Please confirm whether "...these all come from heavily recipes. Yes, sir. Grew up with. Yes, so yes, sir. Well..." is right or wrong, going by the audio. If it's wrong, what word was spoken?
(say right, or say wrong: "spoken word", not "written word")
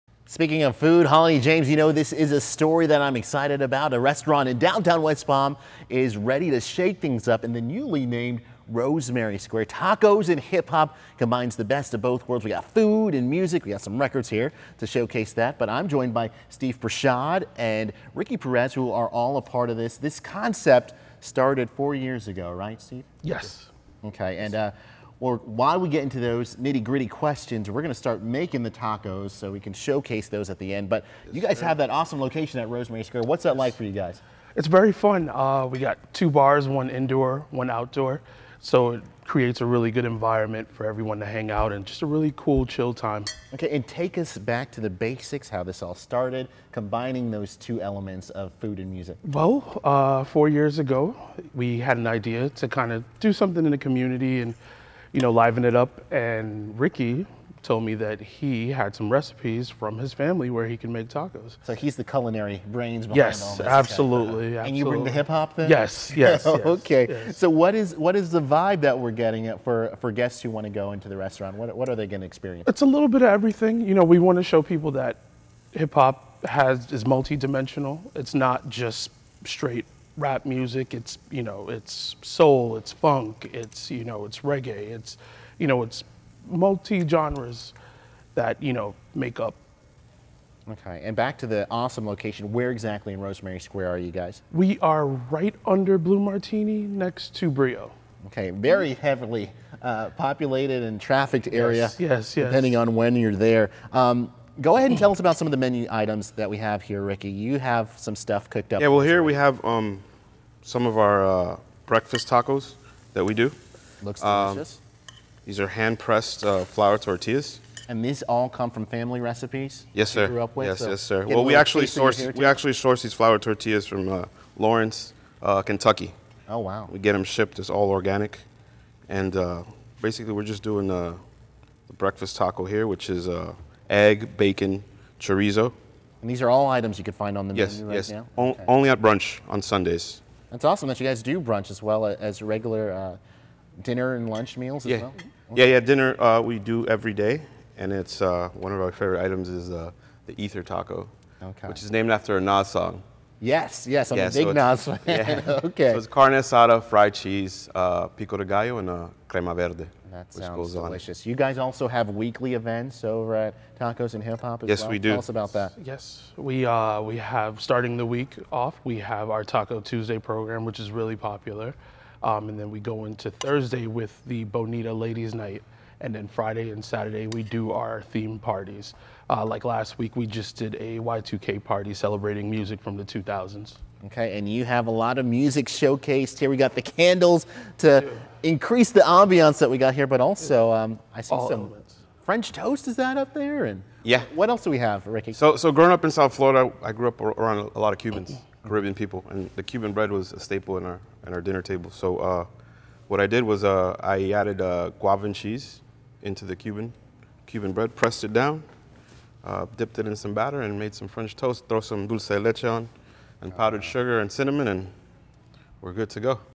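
wrong: "family", not "heavily".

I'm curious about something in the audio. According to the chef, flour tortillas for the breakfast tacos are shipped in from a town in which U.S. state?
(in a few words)
Kentucky.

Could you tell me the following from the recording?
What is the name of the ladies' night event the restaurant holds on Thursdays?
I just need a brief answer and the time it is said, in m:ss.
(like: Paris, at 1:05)
Bonita Ladies Night, at 2:54.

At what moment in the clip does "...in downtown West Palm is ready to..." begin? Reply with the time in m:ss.
0:04.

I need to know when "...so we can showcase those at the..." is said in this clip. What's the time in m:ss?
0:29.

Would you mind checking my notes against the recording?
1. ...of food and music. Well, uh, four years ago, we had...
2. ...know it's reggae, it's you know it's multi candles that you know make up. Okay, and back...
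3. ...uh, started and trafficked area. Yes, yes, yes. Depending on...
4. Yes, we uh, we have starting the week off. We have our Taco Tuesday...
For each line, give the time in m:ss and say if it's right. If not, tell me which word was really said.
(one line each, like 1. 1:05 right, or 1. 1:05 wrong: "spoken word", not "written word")
1. 0:48 right
2. 1:24 wrong: "genres", not "candles"
3. 1:39 wrong: "populated", not "started"
4. 2:45 right.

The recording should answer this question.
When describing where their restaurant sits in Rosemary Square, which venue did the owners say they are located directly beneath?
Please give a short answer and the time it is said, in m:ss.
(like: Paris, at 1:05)
Blue Martini, at 1:35.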